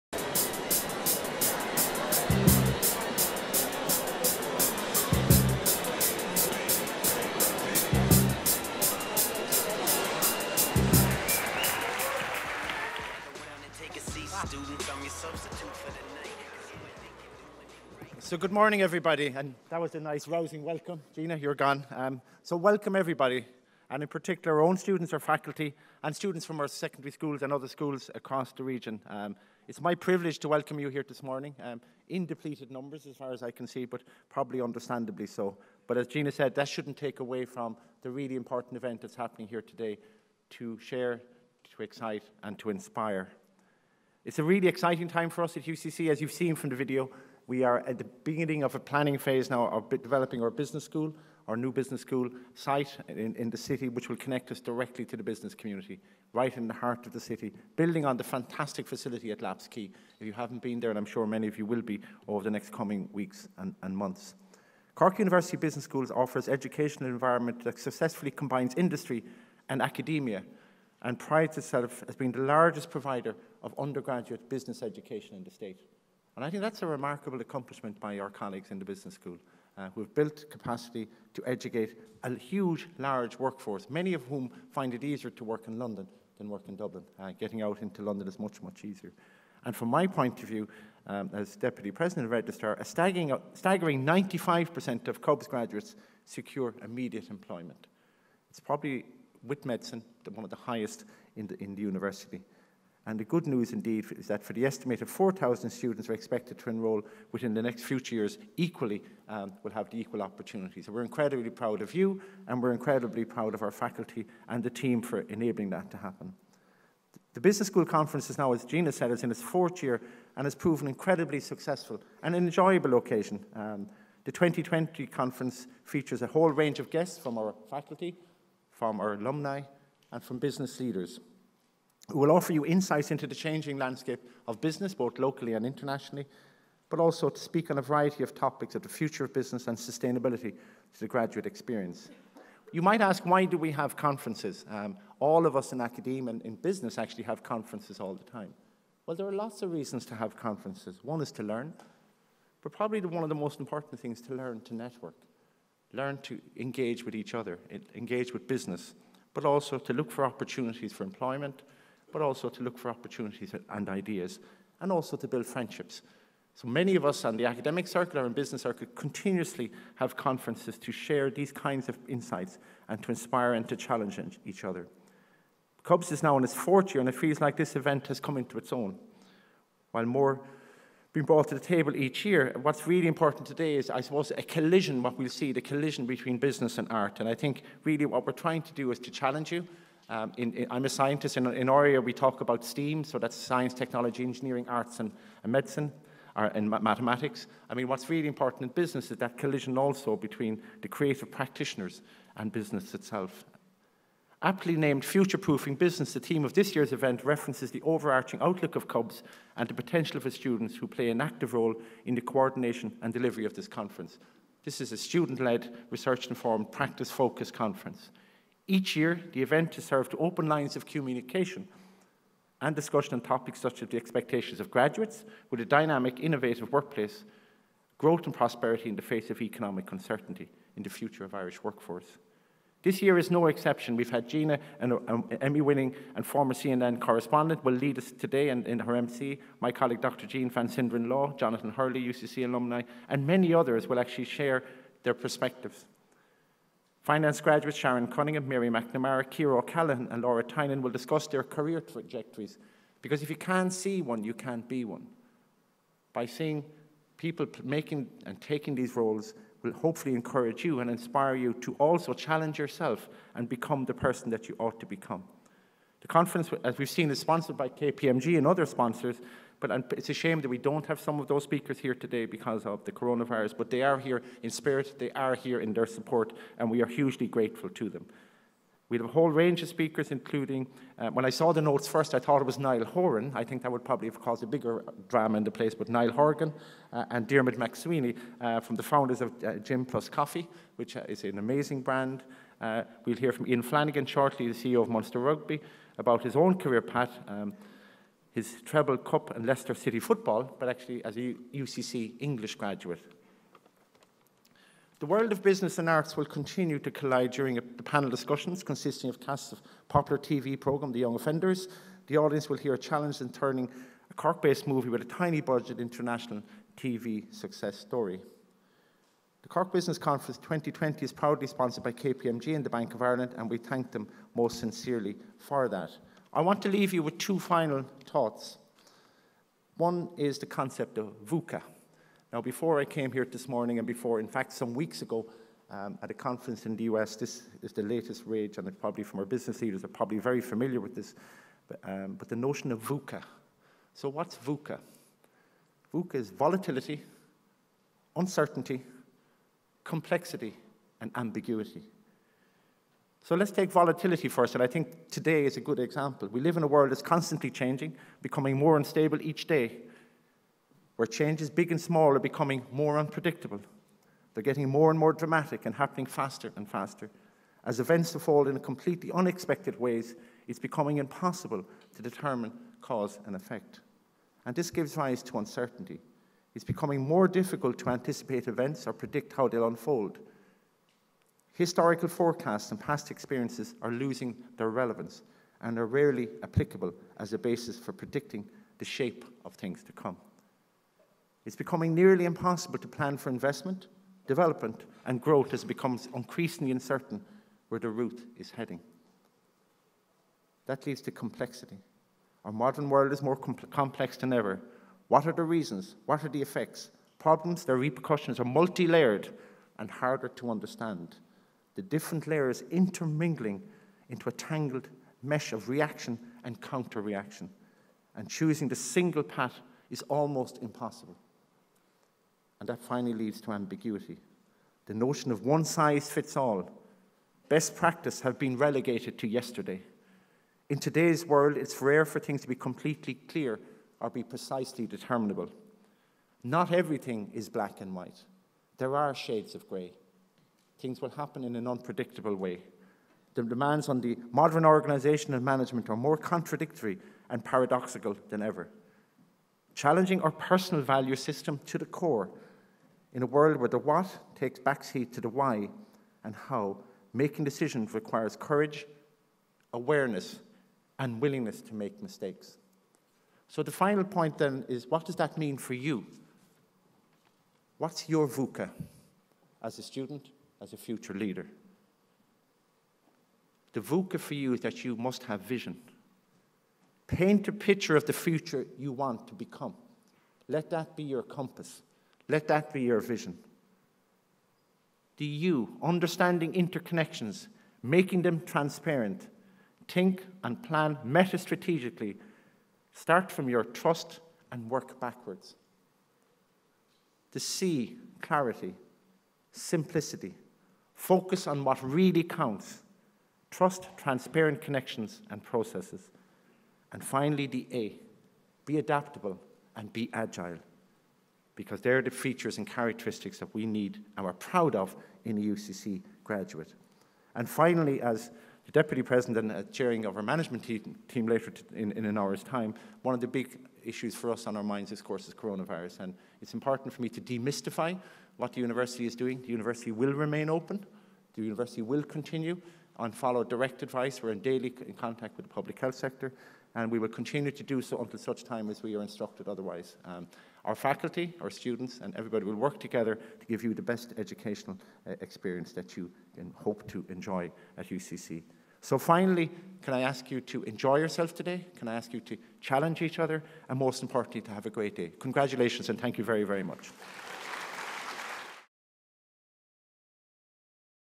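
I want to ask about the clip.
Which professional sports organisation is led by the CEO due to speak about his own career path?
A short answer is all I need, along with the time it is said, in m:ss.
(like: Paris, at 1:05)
Munster Rugby, at 4:54.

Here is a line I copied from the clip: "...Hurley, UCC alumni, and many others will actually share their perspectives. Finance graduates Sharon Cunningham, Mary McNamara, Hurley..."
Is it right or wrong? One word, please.
wrong.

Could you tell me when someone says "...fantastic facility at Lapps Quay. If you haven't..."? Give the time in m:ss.
0:58.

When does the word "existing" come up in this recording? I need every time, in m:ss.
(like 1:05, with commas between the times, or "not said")
not said.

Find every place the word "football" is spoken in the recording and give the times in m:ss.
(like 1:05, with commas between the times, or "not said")
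4:59.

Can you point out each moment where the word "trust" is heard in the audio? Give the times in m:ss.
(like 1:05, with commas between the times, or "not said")
8:13, 8:23.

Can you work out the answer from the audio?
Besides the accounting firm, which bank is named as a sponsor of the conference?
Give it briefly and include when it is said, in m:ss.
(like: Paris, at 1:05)
Bank of Ireland, at 5:22.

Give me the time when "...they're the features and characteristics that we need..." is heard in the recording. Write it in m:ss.
8:31.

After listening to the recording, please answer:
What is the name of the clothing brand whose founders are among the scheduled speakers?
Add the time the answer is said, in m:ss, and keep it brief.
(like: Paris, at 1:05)
Gym Plus Coffee, at 4:49.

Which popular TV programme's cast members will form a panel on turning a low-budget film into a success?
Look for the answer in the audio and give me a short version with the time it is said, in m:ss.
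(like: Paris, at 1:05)
The Young Offenders, at 5:10.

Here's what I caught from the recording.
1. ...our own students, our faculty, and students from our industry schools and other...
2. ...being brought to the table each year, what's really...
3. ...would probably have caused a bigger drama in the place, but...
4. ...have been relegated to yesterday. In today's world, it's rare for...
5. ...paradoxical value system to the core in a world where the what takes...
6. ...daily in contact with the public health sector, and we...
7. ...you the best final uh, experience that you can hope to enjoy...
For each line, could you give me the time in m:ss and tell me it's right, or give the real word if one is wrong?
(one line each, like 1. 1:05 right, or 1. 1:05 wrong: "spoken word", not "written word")
1. 0:24 wrong: "secondary", not "industry"
2. 3:01 right
3. 4:43 right
4. 7:08 right
5. 7:30 wrong: "personal", not "paradoxical"
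6. 8:54 right
7. 9:03 wrong: "educational", not "final".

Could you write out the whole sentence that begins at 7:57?
Paint a picture of the future you want to become.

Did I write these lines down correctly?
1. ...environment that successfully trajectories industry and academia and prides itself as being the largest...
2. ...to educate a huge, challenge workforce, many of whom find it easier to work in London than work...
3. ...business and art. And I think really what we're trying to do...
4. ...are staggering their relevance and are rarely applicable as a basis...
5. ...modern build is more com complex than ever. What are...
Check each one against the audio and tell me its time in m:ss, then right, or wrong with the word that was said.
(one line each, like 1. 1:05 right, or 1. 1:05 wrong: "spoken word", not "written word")
1. 1:07 wrong: "combines", not "trajectories"
2. 1:21 wrong: "large", not "challenge"
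3. 3:06 right
4. 6:23 wrong: "losing", not "staggering"
5. 6:42 wrong: "world", not "build".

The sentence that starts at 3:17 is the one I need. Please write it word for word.
I mean, what's really important in business is that collision also between the creative practitioners and business itself.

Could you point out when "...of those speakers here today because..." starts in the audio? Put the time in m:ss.
4:31.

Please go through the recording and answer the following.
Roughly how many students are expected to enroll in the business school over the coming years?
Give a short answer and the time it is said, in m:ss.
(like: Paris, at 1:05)
4,000, at 1:45.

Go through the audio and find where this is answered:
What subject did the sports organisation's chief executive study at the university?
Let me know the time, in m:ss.
5:02.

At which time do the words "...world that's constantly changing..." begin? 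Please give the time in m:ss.
5:56.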